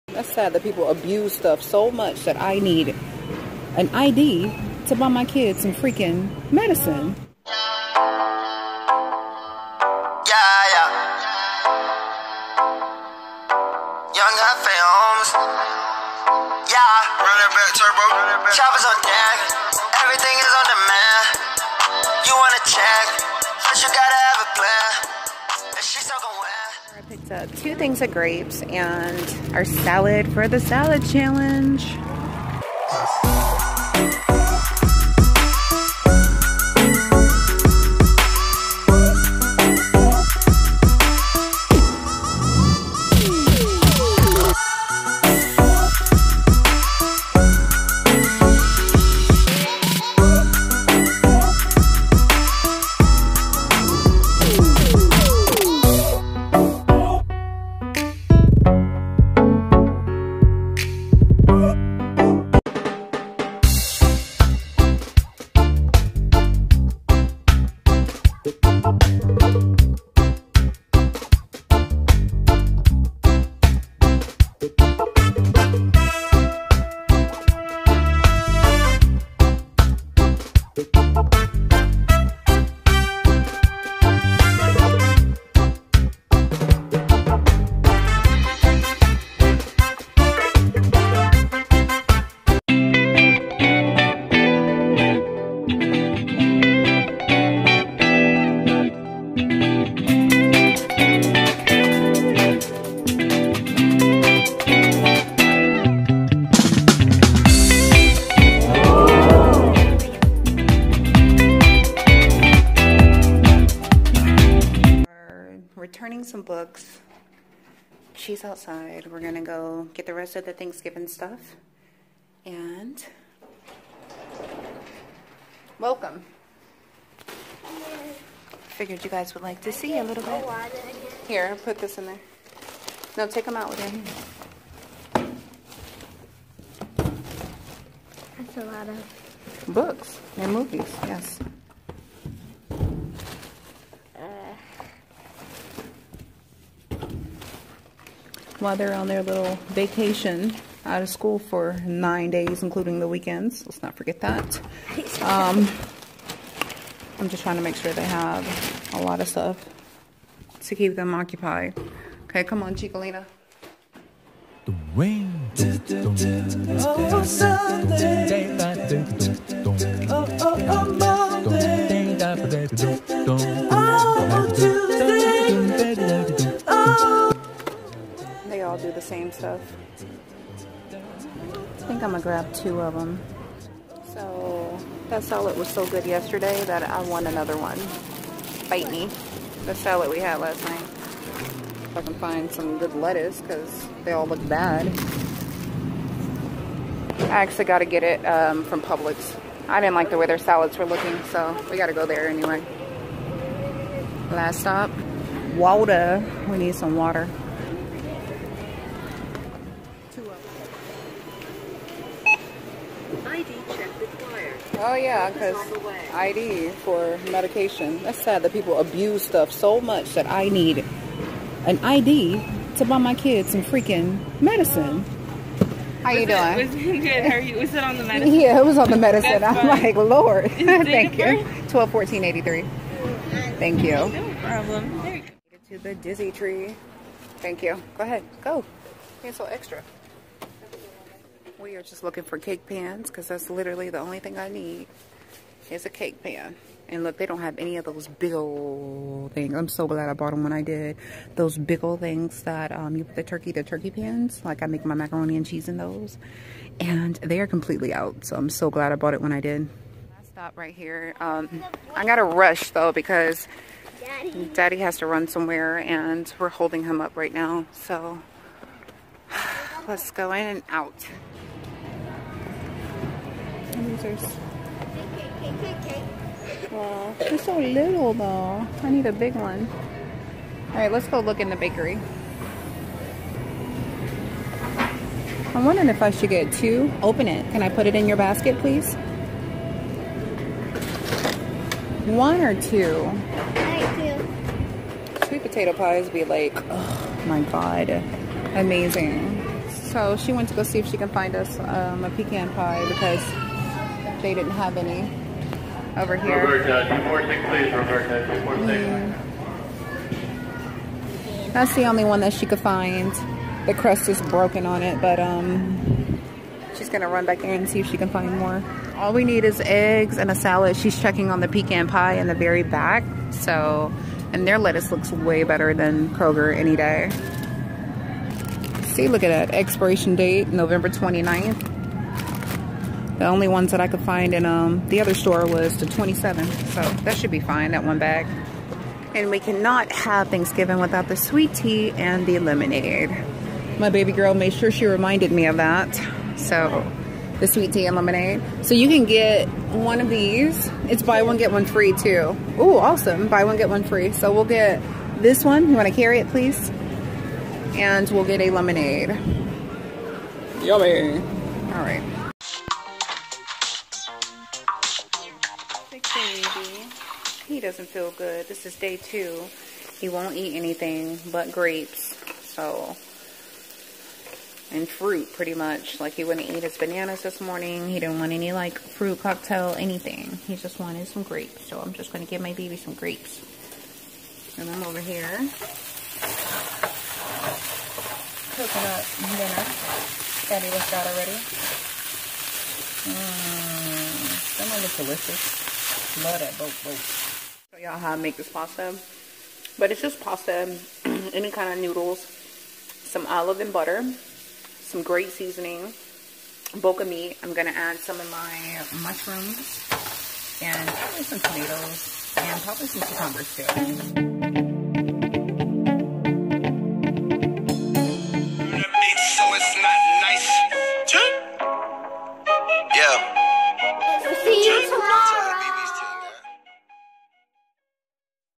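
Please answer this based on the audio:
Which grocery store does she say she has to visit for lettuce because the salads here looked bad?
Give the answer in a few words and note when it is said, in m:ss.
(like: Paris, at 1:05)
Publix, at 3:18.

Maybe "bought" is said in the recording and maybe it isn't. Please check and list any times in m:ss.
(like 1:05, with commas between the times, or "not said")
4:10, 4:18.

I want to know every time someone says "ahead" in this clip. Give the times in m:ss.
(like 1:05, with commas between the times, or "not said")
3:58.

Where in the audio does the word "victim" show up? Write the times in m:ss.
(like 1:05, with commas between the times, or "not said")
not said.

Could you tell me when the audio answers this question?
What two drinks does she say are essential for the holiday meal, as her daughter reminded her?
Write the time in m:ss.
5:41.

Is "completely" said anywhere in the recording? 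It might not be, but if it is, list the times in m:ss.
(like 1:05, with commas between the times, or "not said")
4:17.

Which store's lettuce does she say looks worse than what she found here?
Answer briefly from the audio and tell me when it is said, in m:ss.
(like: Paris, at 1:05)
Kroger, at 5:26.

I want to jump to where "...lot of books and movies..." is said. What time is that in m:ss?
2:18.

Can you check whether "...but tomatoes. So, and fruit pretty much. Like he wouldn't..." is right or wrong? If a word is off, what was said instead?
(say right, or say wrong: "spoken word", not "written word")
wrong: "grapes", not "tomatoes".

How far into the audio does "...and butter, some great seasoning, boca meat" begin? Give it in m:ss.
6:43.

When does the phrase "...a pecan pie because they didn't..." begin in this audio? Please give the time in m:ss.
5:02.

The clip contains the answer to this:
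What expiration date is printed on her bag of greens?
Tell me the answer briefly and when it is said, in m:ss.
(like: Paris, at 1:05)
November 29th, at 5:30.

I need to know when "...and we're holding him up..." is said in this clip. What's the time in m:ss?
4:25.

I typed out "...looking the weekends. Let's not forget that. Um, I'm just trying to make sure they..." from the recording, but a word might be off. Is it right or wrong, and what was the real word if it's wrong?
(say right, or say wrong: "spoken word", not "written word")
wrong: "including", not "looking".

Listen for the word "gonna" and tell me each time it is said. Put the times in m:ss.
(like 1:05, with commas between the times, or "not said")
3:02, 5:16.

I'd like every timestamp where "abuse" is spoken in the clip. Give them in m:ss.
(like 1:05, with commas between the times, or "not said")
0:00, 3:38.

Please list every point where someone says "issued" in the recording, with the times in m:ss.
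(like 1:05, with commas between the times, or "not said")
not said.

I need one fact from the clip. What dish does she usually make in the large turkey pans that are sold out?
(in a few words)
Macaroni and cheese.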